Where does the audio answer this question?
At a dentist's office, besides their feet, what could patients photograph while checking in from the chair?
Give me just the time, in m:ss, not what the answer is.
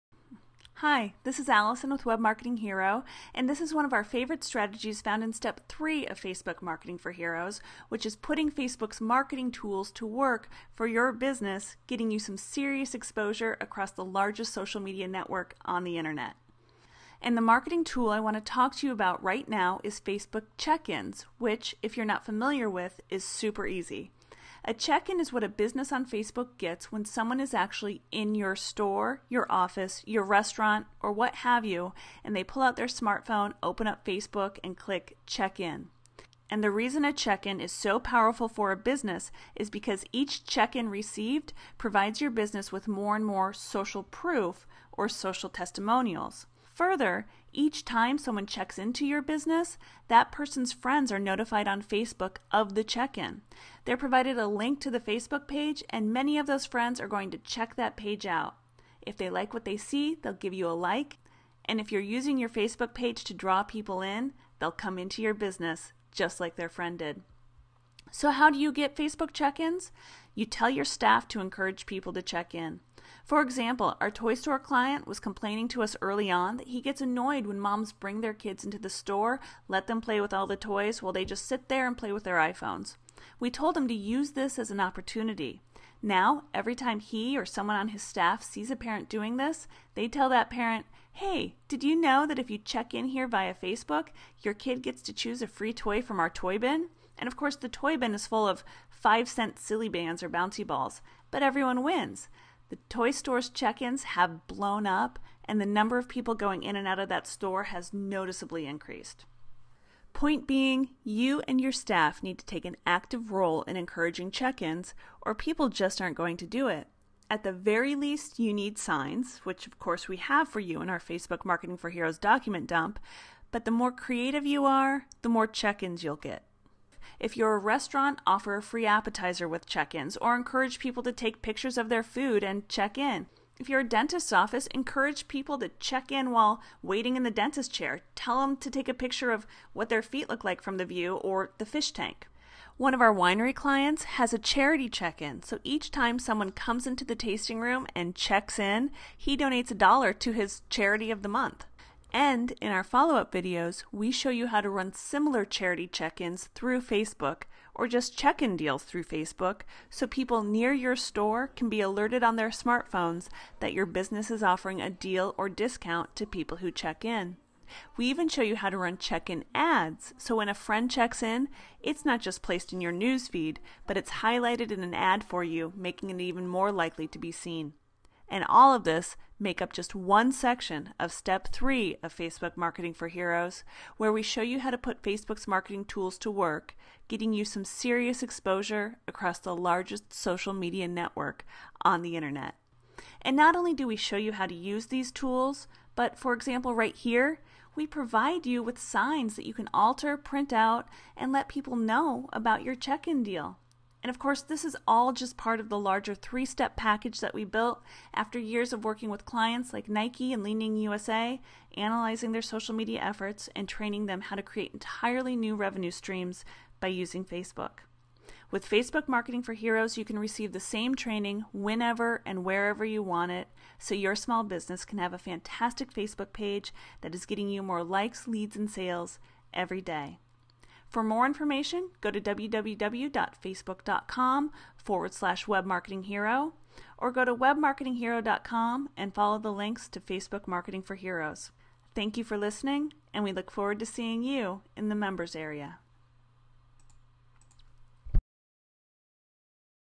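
2:21.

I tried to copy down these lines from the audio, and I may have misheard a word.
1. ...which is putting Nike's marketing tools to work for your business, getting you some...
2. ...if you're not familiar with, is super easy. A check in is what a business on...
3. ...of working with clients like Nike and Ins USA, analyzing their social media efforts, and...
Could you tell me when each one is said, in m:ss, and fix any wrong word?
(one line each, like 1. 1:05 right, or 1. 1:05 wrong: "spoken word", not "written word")
1. 0:07 wrong: "Facebook", not "Nike"
2. 0:21 right
3. 3:28 wrong: "Leaning", not "Ins".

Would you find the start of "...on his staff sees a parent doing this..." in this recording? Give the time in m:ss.
1:27.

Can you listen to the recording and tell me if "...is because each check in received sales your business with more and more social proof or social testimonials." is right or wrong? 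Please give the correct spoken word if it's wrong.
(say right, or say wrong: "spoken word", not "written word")
wrong: "provides", not "sales".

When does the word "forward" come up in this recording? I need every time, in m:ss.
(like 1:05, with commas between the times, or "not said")
3:54, 4:03.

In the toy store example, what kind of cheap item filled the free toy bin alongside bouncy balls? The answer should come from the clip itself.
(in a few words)
5 cent Silly Bandz.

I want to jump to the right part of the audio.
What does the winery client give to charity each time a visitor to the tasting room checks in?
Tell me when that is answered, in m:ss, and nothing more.
2:29.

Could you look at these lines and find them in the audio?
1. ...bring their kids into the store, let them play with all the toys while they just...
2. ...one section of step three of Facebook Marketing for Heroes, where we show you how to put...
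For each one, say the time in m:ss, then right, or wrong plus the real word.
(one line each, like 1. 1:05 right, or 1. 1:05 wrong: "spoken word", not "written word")
1. 1:17 right
2. 2:59 right.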